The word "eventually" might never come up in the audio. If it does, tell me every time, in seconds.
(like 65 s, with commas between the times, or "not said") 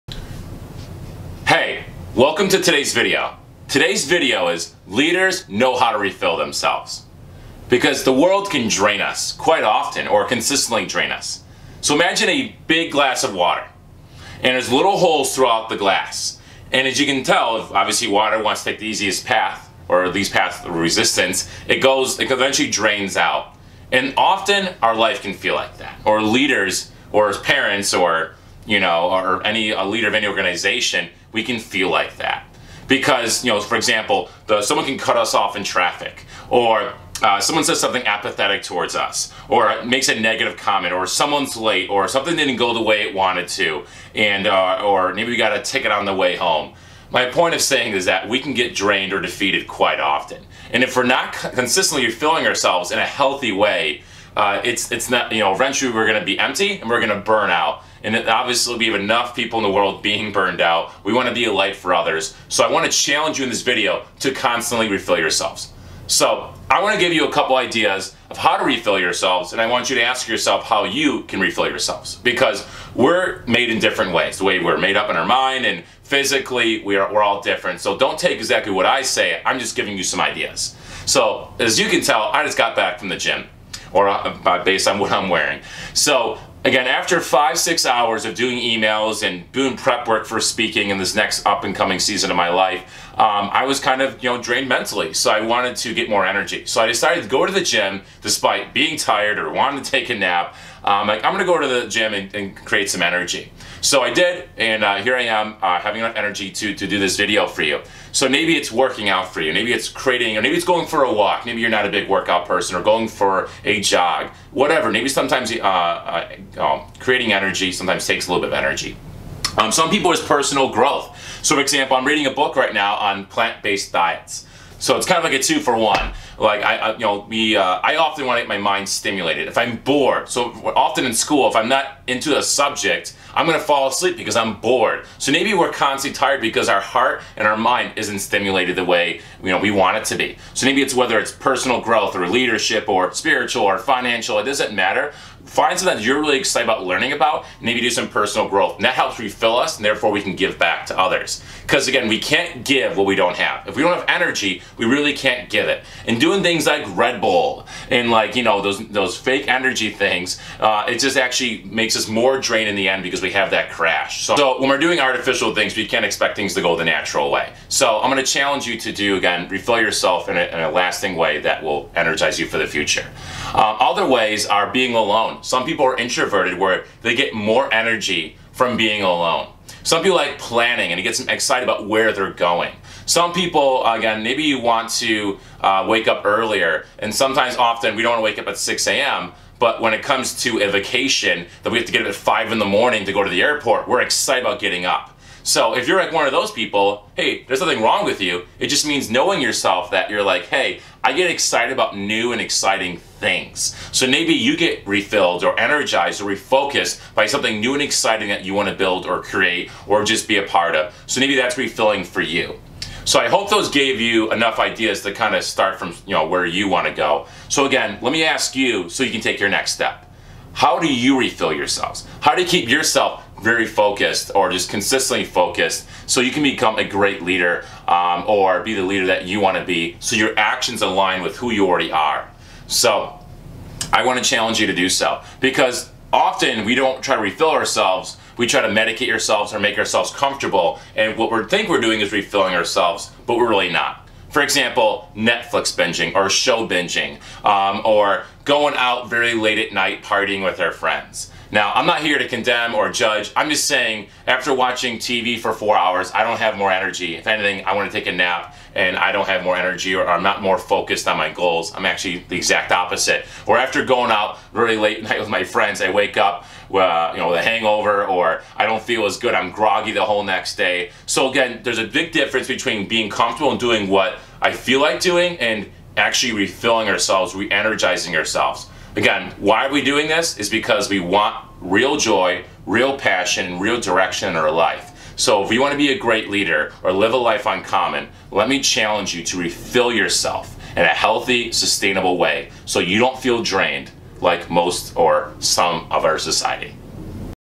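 22 s, 55 s.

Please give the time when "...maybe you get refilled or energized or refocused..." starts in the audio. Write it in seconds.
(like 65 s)
204 s.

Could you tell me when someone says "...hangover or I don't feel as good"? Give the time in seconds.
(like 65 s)
267 s.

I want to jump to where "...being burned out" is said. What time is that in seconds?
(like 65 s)
60 s.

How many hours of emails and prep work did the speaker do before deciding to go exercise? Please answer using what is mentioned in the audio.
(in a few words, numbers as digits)
five, six hours.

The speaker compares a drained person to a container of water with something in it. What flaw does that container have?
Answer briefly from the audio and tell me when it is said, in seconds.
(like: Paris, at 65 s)
little holes, at 14 s.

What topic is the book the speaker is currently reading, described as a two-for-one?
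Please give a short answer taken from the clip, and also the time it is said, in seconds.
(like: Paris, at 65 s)
plant-based diets, at 123 s.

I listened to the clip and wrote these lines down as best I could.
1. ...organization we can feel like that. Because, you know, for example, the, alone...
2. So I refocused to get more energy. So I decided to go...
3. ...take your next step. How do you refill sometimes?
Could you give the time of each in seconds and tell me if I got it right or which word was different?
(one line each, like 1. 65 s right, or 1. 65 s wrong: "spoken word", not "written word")
1. 30 s wrong: "someone", not "alone"
2. 95 s wrong: "wanted", not "refocused"
3. 219 s wrong: "yourselves", not "sometimes".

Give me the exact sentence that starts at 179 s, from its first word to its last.
Some people like planning and it gets them excited about where they're going.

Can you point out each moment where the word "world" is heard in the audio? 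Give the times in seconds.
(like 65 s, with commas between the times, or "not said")
8 s, 59 s.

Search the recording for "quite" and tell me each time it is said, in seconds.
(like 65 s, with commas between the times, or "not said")
9 s, 49 s.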